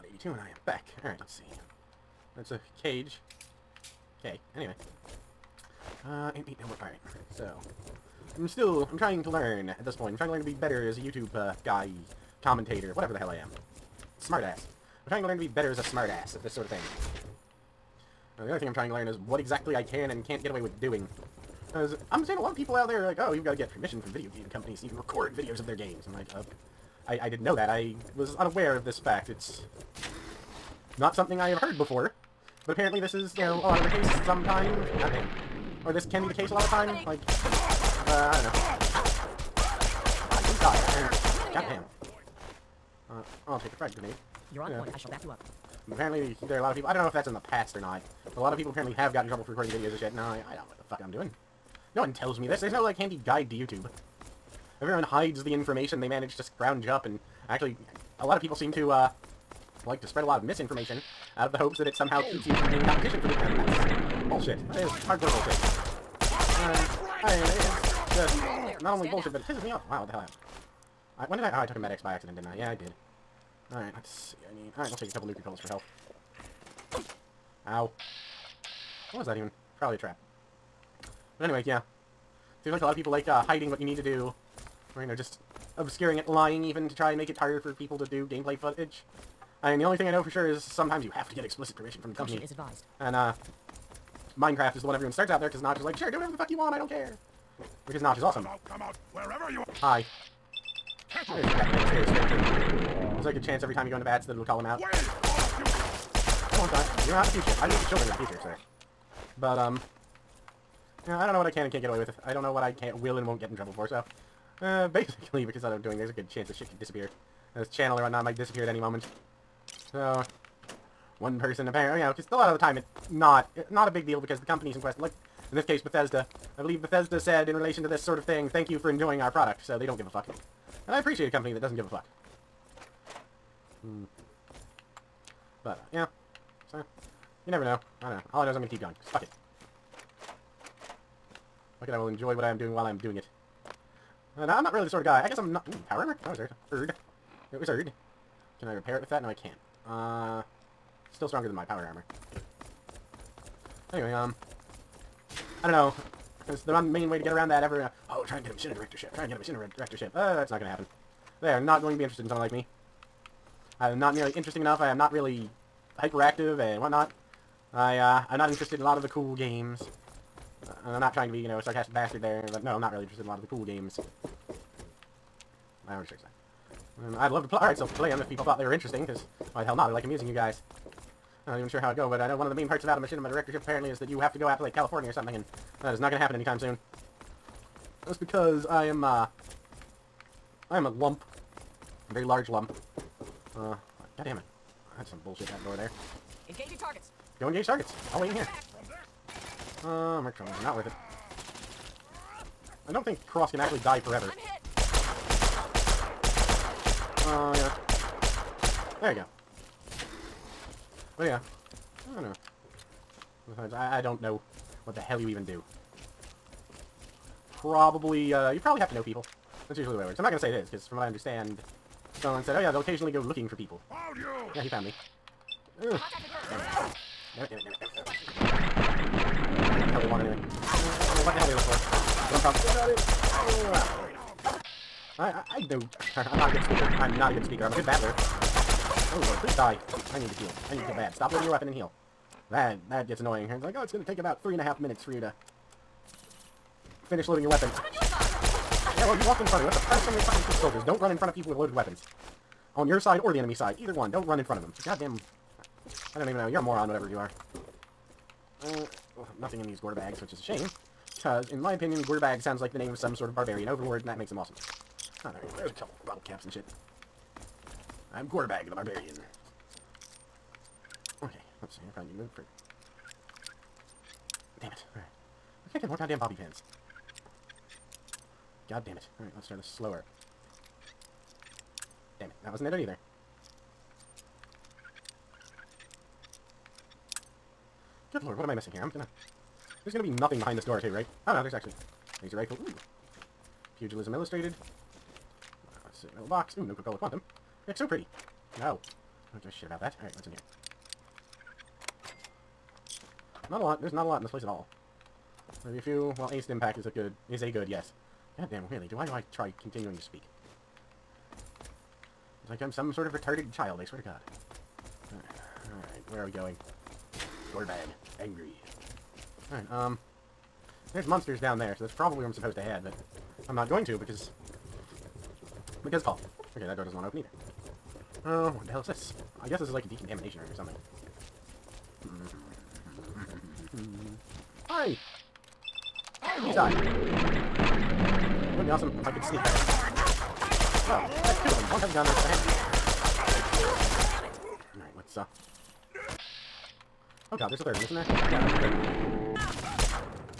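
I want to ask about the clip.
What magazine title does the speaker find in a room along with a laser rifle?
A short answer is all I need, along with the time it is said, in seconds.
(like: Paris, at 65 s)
Pugilism Illustrated, at 293 s.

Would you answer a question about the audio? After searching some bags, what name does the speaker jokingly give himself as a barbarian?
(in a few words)
Gorbag the Barbarian.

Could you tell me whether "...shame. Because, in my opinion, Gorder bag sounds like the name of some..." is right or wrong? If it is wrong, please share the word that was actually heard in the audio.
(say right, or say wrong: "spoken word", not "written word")
right.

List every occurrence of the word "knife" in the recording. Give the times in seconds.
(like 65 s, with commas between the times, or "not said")
not said.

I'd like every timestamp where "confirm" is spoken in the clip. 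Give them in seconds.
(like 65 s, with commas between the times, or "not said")
not said.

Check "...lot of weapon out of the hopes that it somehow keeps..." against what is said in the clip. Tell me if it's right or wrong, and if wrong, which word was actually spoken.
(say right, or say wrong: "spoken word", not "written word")
wrong: "misinformation", not "weapon".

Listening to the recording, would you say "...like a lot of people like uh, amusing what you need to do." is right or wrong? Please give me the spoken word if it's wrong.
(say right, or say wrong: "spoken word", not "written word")
wrong: "hiding", not "amusing".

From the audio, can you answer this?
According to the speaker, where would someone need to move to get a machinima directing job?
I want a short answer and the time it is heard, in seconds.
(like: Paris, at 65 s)
California, at 184 s.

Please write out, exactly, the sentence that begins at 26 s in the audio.
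I'm like, uh, I, I didn't know that.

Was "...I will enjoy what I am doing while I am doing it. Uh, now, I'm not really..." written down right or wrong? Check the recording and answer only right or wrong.
right.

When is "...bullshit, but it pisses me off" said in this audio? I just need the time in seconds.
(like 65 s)
69 s.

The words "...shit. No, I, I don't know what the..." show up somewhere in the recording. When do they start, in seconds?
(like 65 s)
49 s.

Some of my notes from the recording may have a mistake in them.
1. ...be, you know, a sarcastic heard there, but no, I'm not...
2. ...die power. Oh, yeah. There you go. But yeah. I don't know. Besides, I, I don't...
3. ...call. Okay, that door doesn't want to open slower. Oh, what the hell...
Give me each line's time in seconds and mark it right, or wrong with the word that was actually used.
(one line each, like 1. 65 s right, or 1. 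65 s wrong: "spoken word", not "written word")
1. 171 s wrong: "bastard", not "heard"
2. 203 s wrong: "forever", not "power"
3. 326 s wrong: "either", not "slower".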